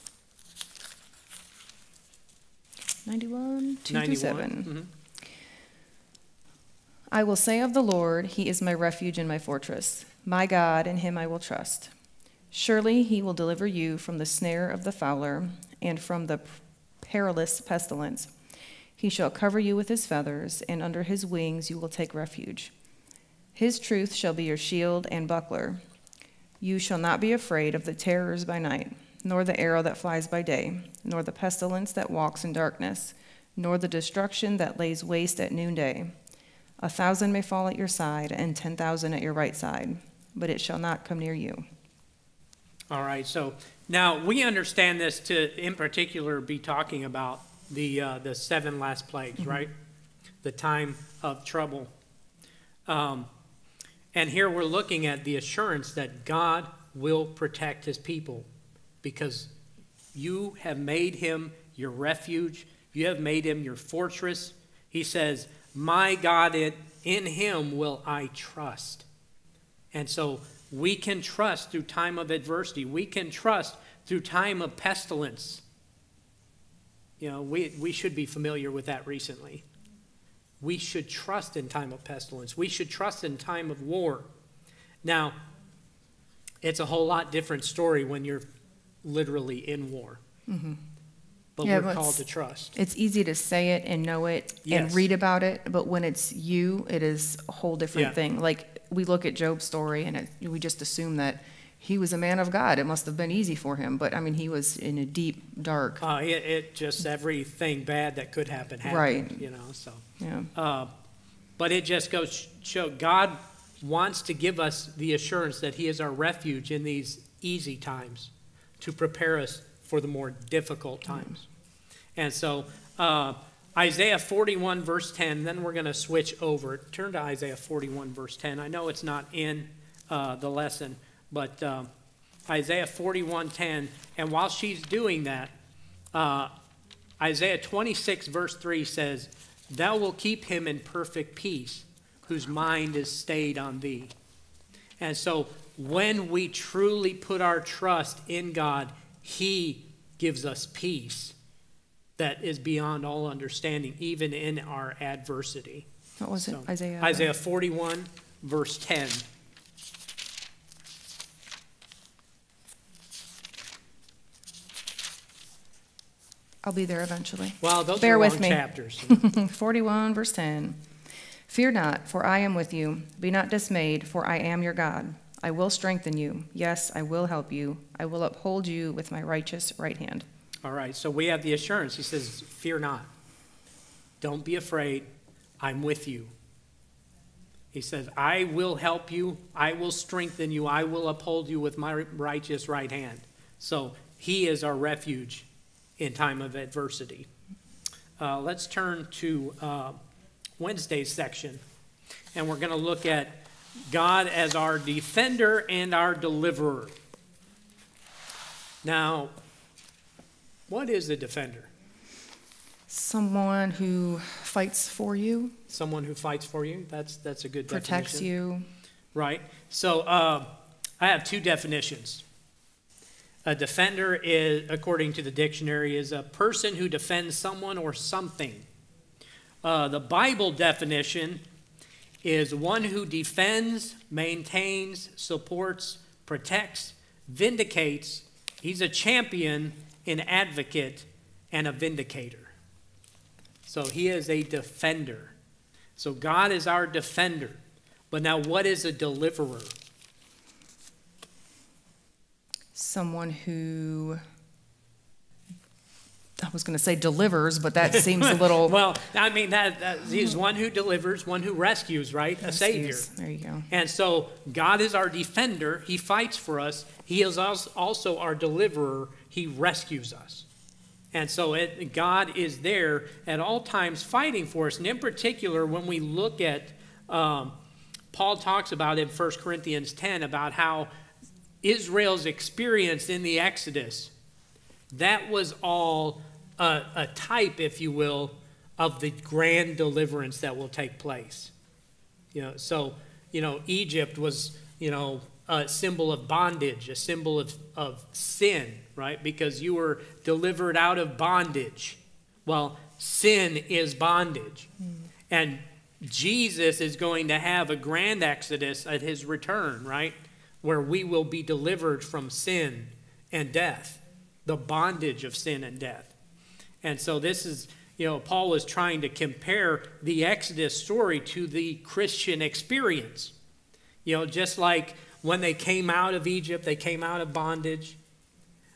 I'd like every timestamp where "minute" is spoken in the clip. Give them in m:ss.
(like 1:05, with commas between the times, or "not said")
not said.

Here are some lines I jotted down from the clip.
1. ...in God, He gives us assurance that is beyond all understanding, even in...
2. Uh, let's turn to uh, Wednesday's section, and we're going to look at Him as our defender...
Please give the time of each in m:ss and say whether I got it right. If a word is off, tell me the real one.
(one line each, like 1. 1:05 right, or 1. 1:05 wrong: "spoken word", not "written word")
1. 2:28 wrong: "peace", not "assurance"
2. 3:18 wrong: "God", not "Him".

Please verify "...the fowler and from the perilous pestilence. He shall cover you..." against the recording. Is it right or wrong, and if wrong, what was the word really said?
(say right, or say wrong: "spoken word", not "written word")
right.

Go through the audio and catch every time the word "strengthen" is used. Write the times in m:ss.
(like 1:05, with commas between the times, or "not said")
2:55, 3:09.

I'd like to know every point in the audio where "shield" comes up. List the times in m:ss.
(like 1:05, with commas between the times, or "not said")
0:24.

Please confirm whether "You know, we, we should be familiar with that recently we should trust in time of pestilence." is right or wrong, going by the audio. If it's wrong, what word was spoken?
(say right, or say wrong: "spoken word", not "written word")
right.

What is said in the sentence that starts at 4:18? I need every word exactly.
well, I mean, that, that he's one who delivers, one who rescues, right?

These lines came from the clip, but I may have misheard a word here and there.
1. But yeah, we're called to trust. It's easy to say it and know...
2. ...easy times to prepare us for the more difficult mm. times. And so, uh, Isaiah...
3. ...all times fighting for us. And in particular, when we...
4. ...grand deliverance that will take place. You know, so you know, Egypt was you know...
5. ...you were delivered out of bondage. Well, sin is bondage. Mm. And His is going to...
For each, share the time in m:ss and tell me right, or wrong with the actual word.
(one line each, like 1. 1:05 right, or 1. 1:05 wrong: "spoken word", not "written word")
1. 1:31 right
2. 1:57 right
3. 4:33 right
4. 4:49 right
5. 4:59 wrong: "Jesus", not "His".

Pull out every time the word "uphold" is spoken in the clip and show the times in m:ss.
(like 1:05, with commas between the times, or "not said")
2:58, 3:11.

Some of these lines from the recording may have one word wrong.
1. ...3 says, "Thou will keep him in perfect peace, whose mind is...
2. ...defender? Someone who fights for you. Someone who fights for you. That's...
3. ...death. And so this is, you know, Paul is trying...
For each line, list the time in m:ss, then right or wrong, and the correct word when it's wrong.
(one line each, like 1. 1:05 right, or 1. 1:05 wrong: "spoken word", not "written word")
1. 2:18 right
2. 3:31 right
3. 5:15 right.